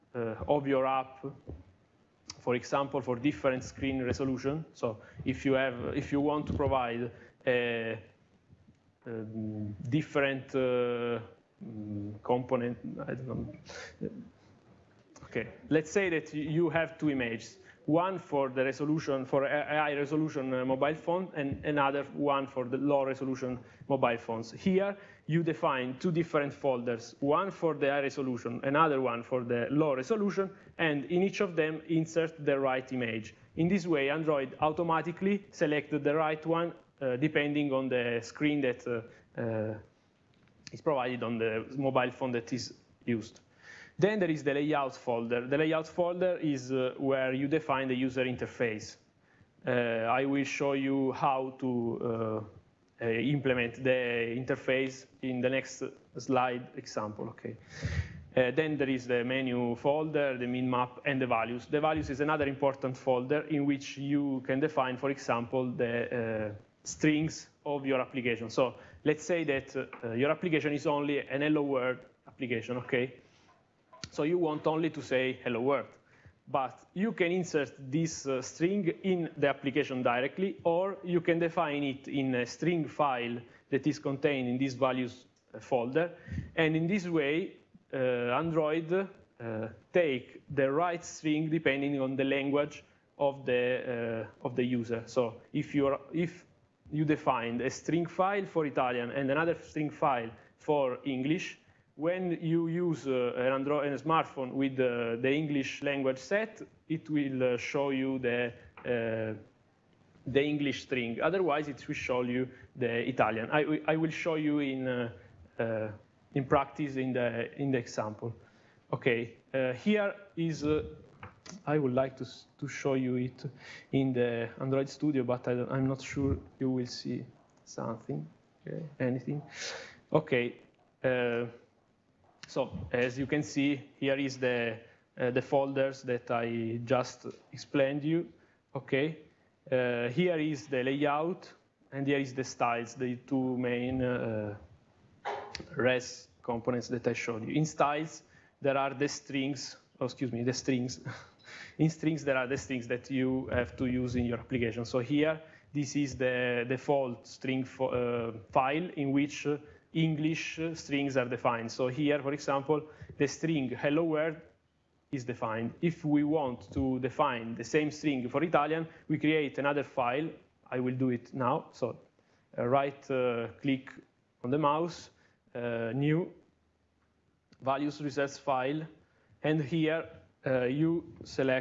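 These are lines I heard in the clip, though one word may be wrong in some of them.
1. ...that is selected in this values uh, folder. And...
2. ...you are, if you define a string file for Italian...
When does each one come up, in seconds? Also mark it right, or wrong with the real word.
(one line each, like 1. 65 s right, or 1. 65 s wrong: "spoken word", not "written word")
1. 83 s wrong: "contained", not "selected"
2. 95 s right.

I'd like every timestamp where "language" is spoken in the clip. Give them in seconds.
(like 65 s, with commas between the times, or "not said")
92 s, 105 s.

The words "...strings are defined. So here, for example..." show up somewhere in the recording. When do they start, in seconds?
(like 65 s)
160 s.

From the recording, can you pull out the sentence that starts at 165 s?
If we want to define the same string for Italian, we create another file.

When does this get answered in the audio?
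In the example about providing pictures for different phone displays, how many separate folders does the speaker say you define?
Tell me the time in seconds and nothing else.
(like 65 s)
26 s.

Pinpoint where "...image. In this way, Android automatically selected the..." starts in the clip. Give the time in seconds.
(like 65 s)
32 s.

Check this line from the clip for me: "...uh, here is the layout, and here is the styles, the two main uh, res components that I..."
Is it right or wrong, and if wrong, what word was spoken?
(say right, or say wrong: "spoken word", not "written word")
right.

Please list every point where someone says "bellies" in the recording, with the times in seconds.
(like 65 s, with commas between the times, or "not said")
not said.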